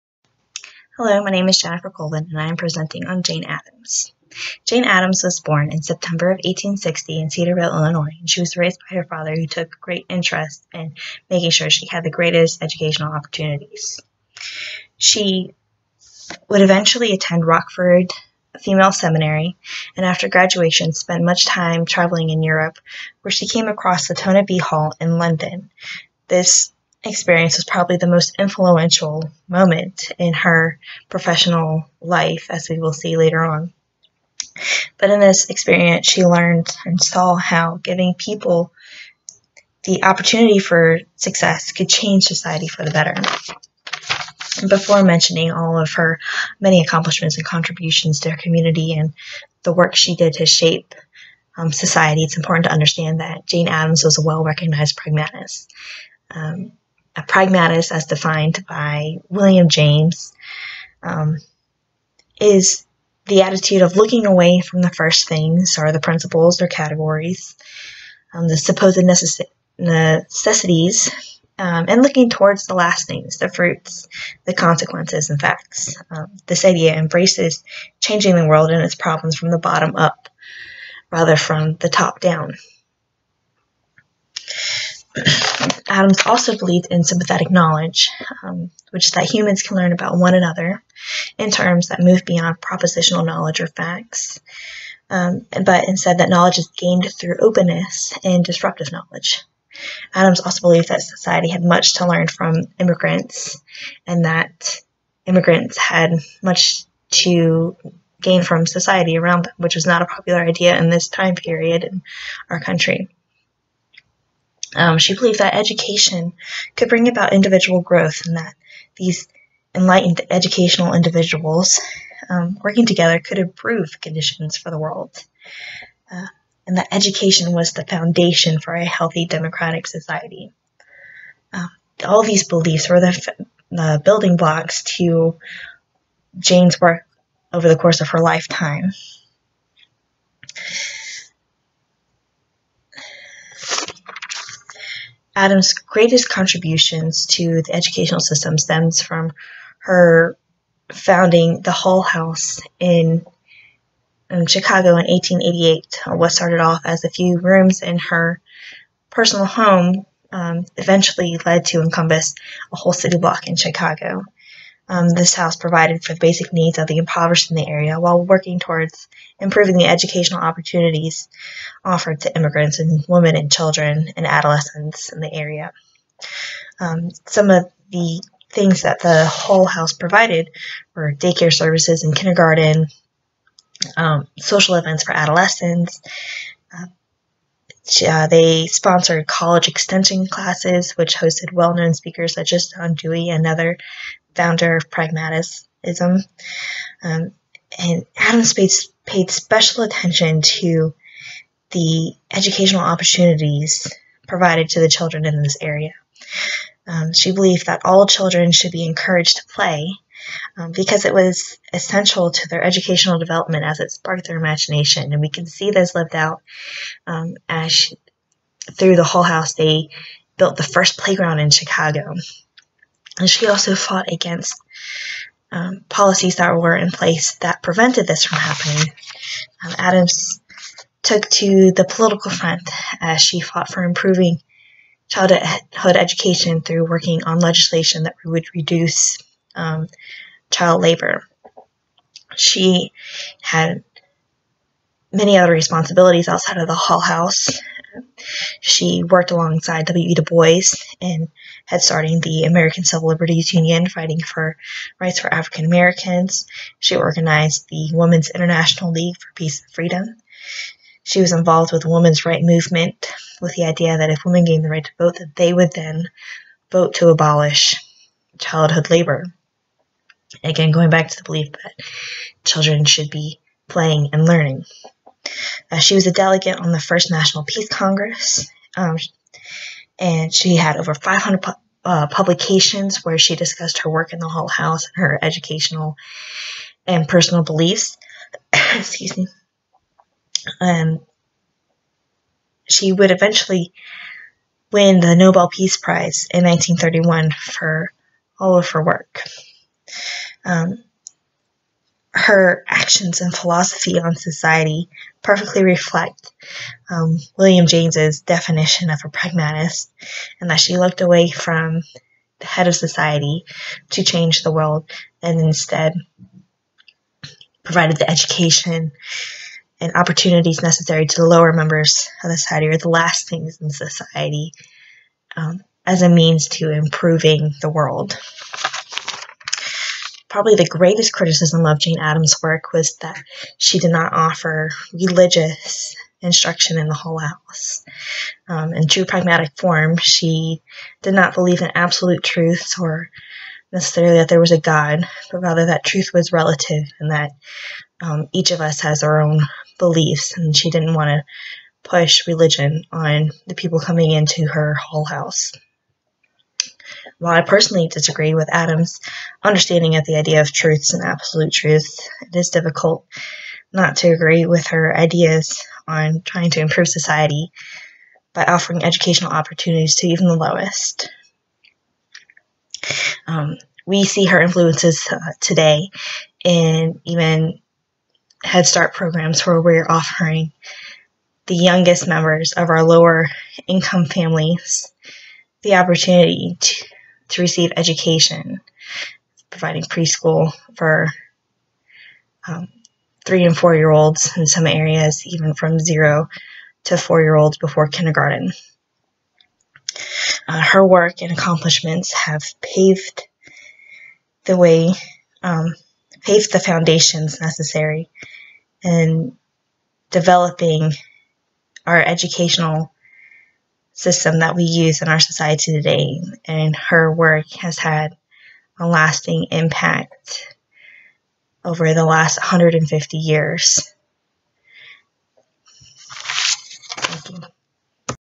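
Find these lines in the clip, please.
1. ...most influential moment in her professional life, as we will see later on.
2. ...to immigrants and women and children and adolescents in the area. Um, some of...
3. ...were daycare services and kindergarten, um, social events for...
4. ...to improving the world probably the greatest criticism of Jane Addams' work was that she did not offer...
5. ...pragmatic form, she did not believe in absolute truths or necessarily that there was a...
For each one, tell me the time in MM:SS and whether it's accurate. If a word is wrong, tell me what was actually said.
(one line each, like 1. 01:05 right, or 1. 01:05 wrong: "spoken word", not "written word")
1. 00:28 right
2. 02:52 right
3. 03:00 right
4. 05:26 right
5. 05:39 right.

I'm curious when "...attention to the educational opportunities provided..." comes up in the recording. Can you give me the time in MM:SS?
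03:19.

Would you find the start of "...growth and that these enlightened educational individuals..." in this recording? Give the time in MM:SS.
01:57.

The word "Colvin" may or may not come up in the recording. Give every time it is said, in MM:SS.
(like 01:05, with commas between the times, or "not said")
00:01.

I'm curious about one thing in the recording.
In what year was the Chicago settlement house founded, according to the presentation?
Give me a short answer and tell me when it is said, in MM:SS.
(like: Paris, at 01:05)
1888, at 02:35.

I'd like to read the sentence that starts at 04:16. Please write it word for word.
She organized the Women's International League for Peace and Freedom.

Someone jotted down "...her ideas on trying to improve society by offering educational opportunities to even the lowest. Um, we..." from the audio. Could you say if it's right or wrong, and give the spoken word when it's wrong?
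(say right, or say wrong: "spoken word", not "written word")
right.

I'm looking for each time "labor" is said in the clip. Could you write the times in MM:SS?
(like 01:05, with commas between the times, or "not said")
04:00, 04:28.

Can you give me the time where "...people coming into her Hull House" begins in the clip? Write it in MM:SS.
05:53.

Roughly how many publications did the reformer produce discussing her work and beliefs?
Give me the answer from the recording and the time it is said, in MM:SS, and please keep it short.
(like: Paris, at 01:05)
over 500, at 04:40.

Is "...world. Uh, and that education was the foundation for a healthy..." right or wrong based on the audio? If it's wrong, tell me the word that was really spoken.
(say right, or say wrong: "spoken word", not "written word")
right.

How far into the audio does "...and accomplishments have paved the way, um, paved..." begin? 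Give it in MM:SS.
06:41.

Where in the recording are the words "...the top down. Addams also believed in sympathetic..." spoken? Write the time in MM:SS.
01:21.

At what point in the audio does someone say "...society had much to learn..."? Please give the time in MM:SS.
01:41.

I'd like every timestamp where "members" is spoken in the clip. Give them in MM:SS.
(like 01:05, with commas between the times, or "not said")
05:21, 06:22.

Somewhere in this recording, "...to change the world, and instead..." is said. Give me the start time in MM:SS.
05:13.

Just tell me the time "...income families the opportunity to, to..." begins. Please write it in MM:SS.
06:23.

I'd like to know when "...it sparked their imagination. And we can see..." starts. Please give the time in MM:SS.
03:33.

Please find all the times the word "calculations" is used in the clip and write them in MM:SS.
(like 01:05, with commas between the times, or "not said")
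not said.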